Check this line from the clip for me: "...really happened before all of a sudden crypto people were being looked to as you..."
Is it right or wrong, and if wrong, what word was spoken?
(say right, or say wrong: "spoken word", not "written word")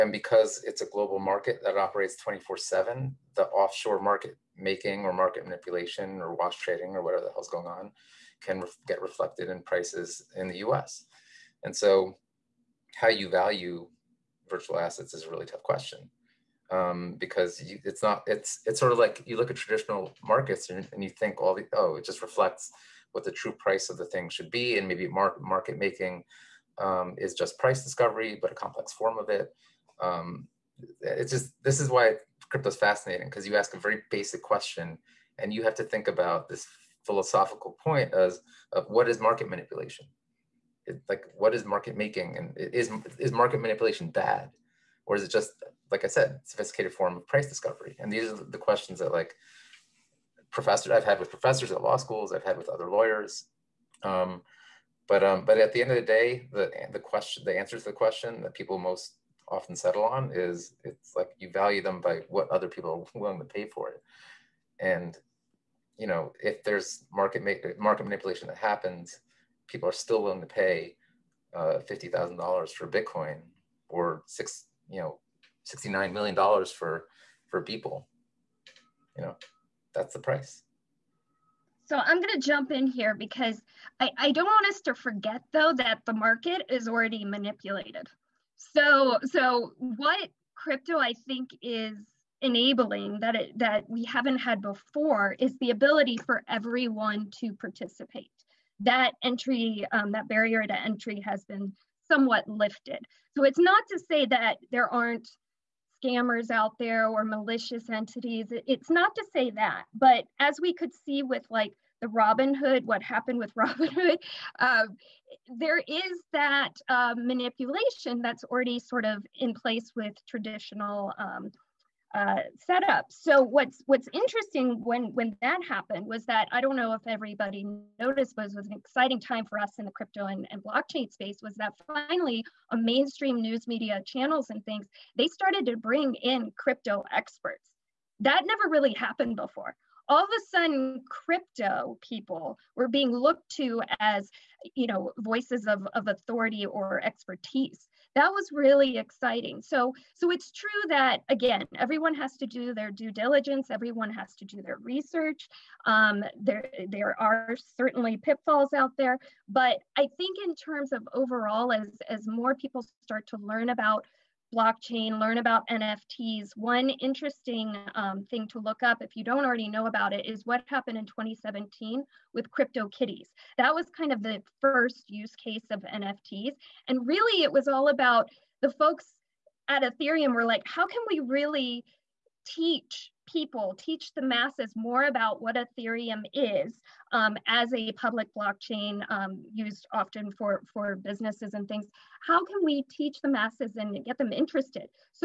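right.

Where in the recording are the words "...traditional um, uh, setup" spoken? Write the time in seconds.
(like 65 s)
120 s.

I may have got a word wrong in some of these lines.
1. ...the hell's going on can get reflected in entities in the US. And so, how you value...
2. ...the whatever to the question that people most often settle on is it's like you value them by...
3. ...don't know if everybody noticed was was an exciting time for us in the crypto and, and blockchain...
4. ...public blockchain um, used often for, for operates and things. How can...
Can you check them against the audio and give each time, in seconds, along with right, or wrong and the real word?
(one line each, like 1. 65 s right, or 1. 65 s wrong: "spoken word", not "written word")
1. 7 s wrong: "prices", not "entities"
2. 57 s wrong: "answer", not "whatever"
3. 126 s right
4. 187 s wrong: "businesses", not "operates".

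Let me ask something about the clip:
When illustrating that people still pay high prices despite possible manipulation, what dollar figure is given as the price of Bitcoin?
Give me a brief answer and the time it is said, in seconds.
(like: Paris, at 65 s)
$50,000, at 71 s.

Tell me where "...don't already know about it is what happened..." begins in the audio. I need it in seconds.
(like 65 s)
169 s.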